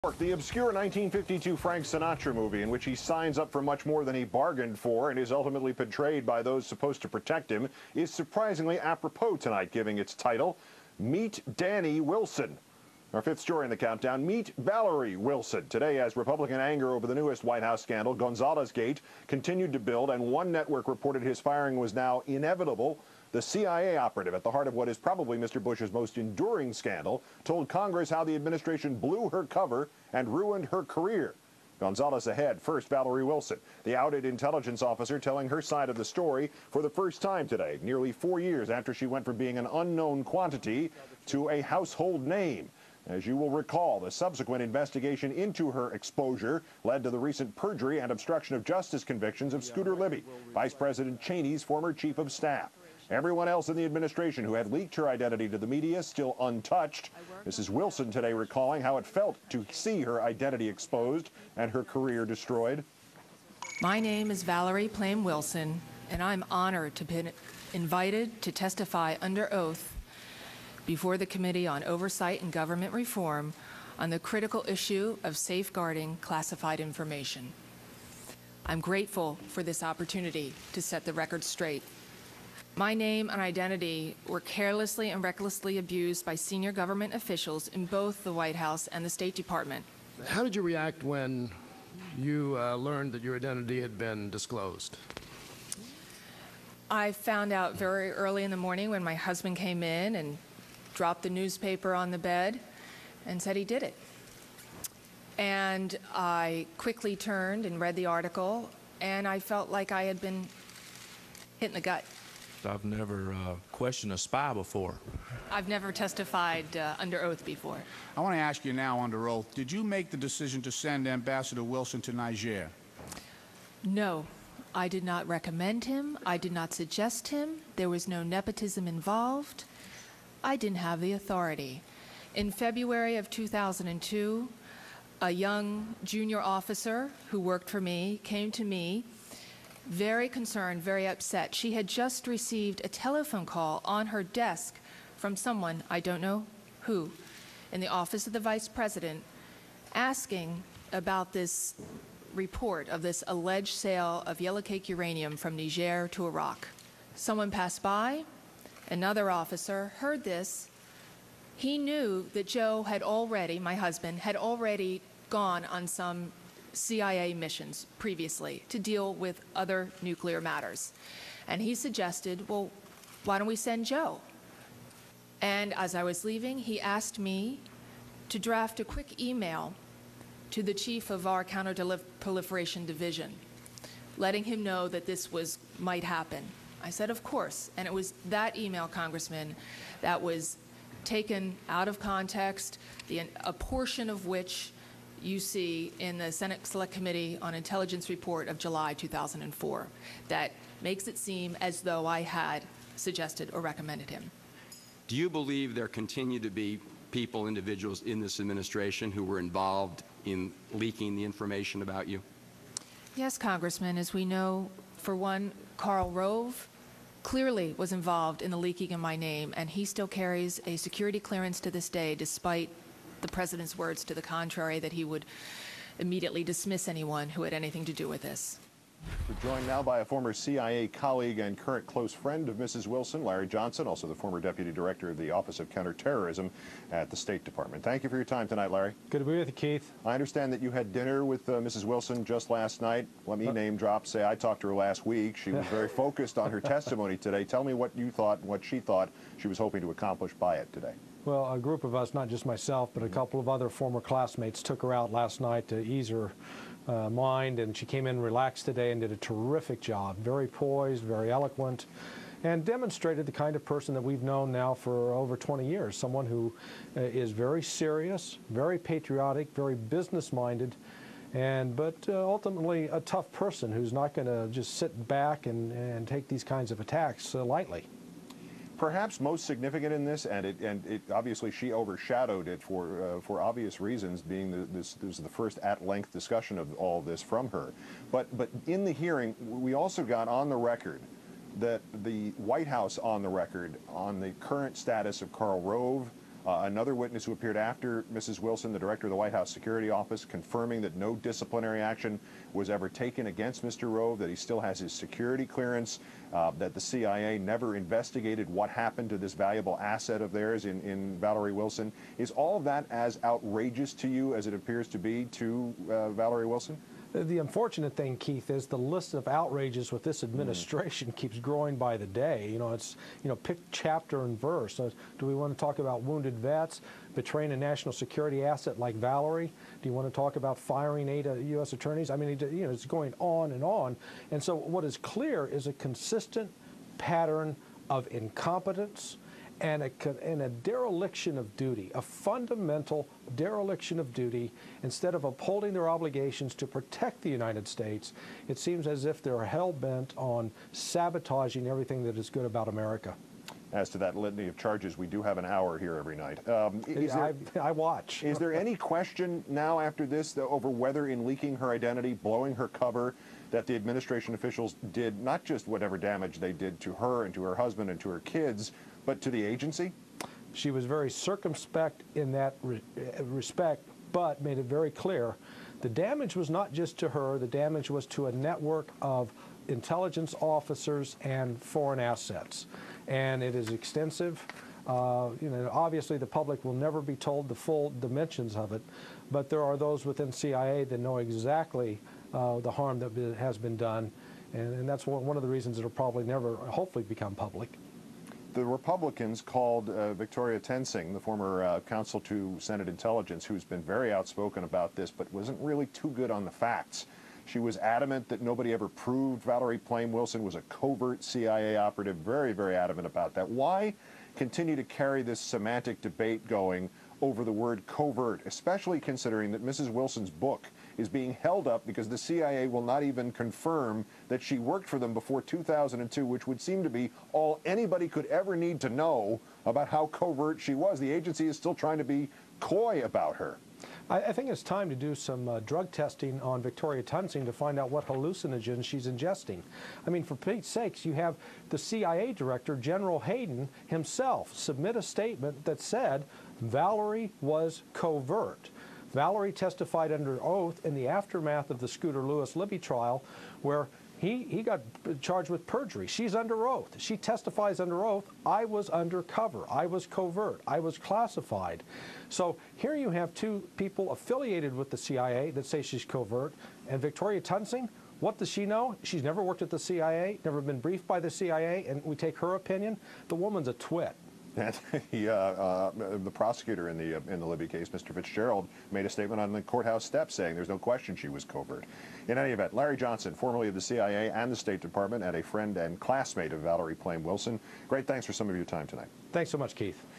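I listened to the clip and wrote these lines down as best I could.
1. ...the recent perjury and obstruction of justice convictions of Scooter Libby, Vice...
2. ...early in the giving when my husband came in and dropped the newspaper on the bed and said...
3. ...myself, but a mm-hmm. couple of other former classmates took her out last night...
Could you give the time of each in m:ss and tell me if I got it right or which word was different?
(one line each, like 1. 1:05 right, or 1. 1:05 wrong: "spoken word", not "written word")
1. 0:47 right
2. 1:38 wrong: "morning", not "giving"
3. 4:12 right.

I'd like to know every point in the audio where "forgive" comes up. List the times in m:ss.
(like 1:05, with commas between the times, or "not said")
not said.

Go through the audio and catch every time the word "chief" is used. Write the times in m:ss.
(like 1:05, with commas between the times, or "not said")
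0:51, 3:00.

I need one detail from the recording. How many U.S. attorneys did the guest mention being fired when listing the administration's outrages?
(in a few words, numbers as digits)
8.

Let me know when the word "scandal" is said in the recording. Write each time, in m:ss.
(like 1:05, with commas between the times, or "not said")
0:17, 0:26.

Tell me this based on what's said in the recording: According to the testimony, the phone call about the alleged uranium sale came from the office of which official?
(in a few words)
the vice president.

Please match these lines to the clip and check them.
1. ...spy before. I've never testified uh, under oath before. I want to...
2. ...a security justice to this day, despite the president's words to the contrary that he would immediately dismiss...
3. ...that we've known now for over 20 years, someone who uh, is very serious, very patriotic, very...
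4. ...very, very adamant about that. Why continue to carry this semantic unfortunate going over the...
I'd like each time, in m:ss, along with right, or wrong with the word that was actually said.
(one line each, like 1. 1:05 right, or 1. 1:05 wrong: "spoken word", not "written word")
1. 1:54 right
2. 3:40 wrong: "clearance", not "justice"
3. 4:23 right
4. 6:52 wrong: "debate", not "unfortunate".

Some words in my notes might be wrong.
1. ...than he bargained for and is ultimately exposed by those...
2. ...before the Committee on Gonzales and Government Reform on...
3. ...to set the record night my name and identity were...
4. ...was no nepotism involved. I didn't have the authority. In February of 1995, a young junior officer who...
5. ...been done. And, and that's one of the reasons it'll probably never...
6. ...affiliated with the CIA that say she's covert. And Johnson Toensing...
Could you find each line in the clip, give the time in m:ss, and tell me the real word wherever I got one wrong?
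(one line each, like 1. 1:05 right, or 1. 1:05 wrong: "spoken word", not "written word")
1. 0:04 wrong: "betrayed", not "exposed"
2. 1:10 wrong: "Oversight", not "Gonzales"
3. 1:20 wrong: "straight", not "night"
4. 2:07 wrong: "2002", not "1995"
5. 6:33 right
6. 7:44 wrong: "Victoria", not "Johnson".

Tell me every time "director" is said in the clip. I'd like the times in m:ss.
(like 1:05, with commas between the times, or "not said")
3:54, 4:58, 7:22.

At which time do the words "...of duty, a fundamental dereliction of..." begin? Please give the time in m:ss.
5:41.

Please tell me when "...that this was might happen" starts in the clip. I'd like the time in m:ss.
3:04.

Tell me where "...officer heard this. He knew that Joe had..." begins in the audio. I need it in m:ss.
2:39.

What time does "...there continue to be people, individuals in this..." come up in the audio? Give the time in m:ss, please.
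3:25.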